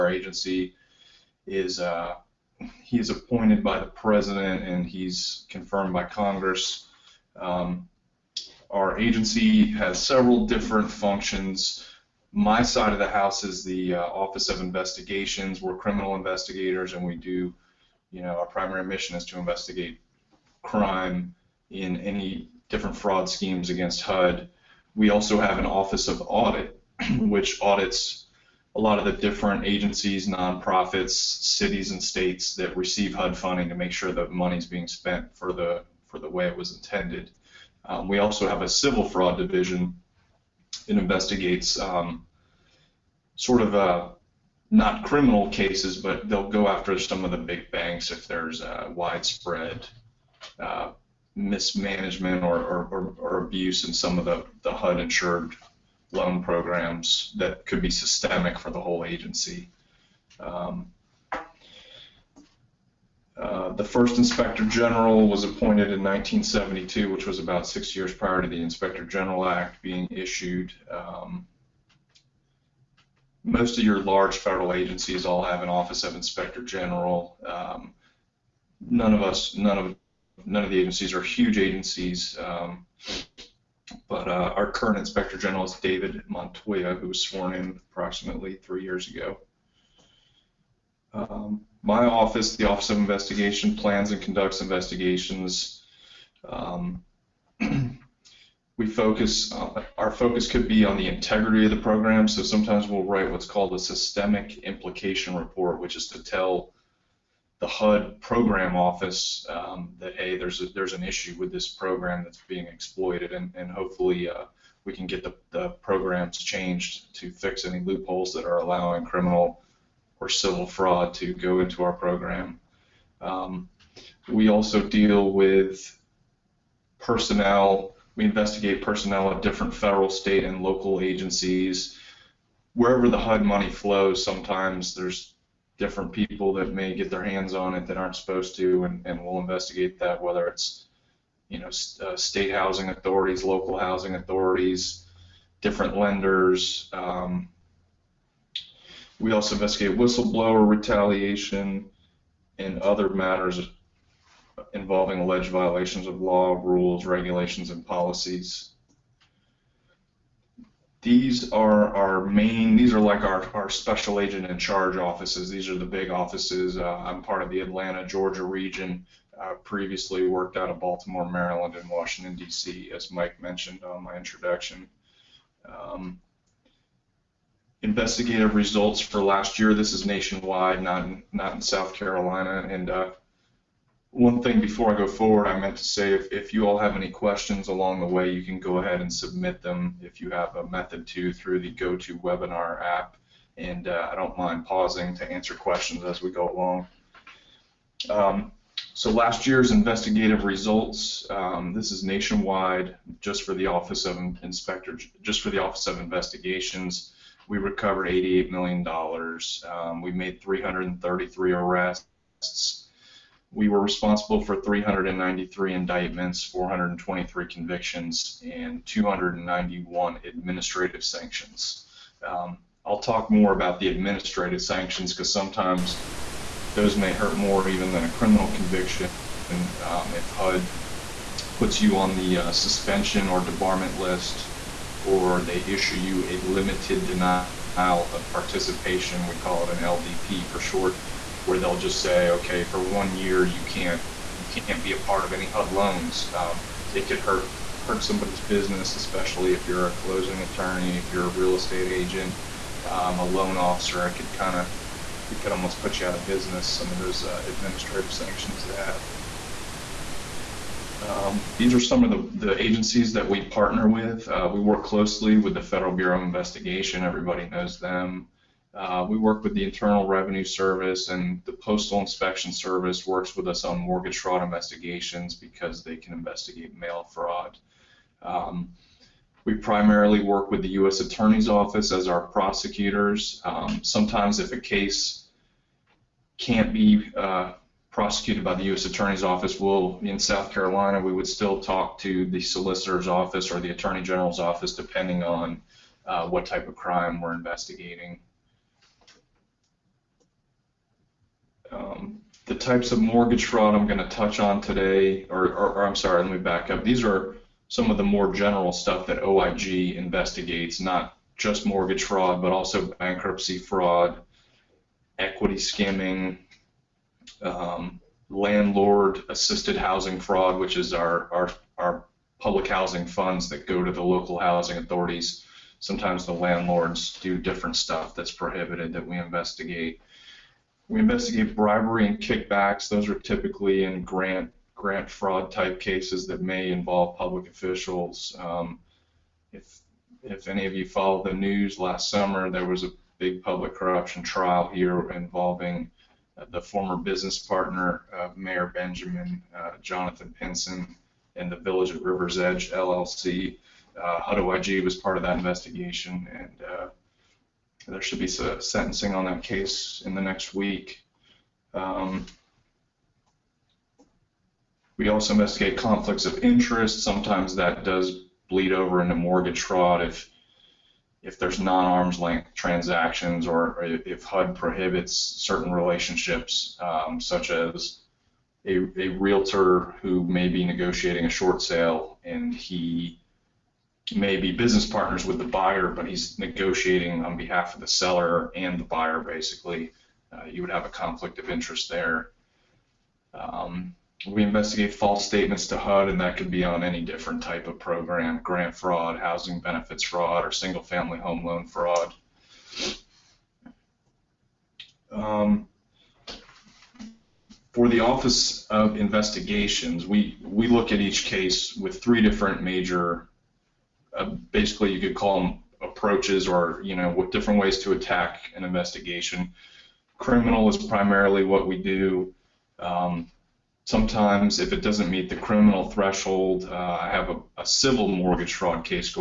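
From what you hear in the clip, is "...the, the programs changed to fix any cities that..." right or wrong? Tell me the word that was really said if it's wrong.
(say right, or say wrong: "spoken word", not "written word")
wrong: "loopholes", not "cities".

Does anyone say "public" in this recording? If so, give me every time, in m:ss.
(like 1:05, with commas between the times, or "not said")
5:22, 5:37, 5:43.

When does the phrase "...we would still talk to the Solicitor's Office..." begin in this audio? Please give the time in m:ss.
4:51.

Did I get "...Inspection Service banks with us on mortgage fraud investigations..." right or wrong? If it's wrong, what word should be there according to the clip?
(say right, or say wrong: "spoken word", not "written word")
wrong: "works", not "banks".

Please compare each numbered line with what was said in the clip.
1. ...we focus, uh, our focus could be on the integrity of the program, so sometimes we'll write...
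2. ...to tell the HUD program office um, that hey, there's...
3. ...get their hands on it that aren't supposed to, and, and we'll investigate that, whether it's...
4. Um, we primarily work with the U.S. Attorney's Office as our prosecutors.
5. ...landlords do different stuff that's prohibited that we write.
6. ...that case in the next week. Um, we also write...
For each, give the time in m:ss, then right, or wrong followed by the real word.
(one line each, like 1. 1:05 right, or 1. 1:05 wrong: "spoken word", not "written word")
1. 1:38 right
2. 1:46 right
3. 2:16 right
4. 4:38 right
5. 5:26 wrong: "investigate", not "write"
6. 5:59 wrong: "investigate", not "write".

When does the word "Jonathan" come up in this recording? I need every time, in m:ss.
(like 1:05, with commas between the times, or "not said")
5:49.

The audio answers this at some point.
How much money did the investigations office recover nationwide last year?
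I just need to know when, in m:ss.
3:28.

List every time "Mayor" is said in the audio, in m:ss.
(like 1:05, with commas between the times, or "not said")
5:48.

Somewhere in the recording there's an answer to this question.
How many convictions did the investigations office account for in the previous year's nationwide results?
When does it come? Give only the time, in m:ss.
3:36.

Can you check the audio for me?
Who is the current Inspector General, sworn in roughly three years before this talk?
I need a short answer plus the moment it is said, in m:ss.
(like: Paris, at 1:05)
David Montoya, at 1:25.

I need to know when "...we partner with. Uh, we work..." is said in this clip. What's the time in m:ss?
4:23.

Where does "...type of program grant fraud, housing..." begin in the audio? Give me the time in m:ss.
6:37.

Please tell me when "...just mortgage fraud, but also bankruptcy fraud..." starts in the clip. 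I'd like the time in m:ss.
5:11.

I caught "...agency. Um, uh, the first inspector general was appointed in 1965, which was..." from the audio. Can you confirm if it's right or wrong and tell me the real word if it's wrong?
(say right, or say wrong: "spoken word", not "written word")
wrong: "1972", not "1965".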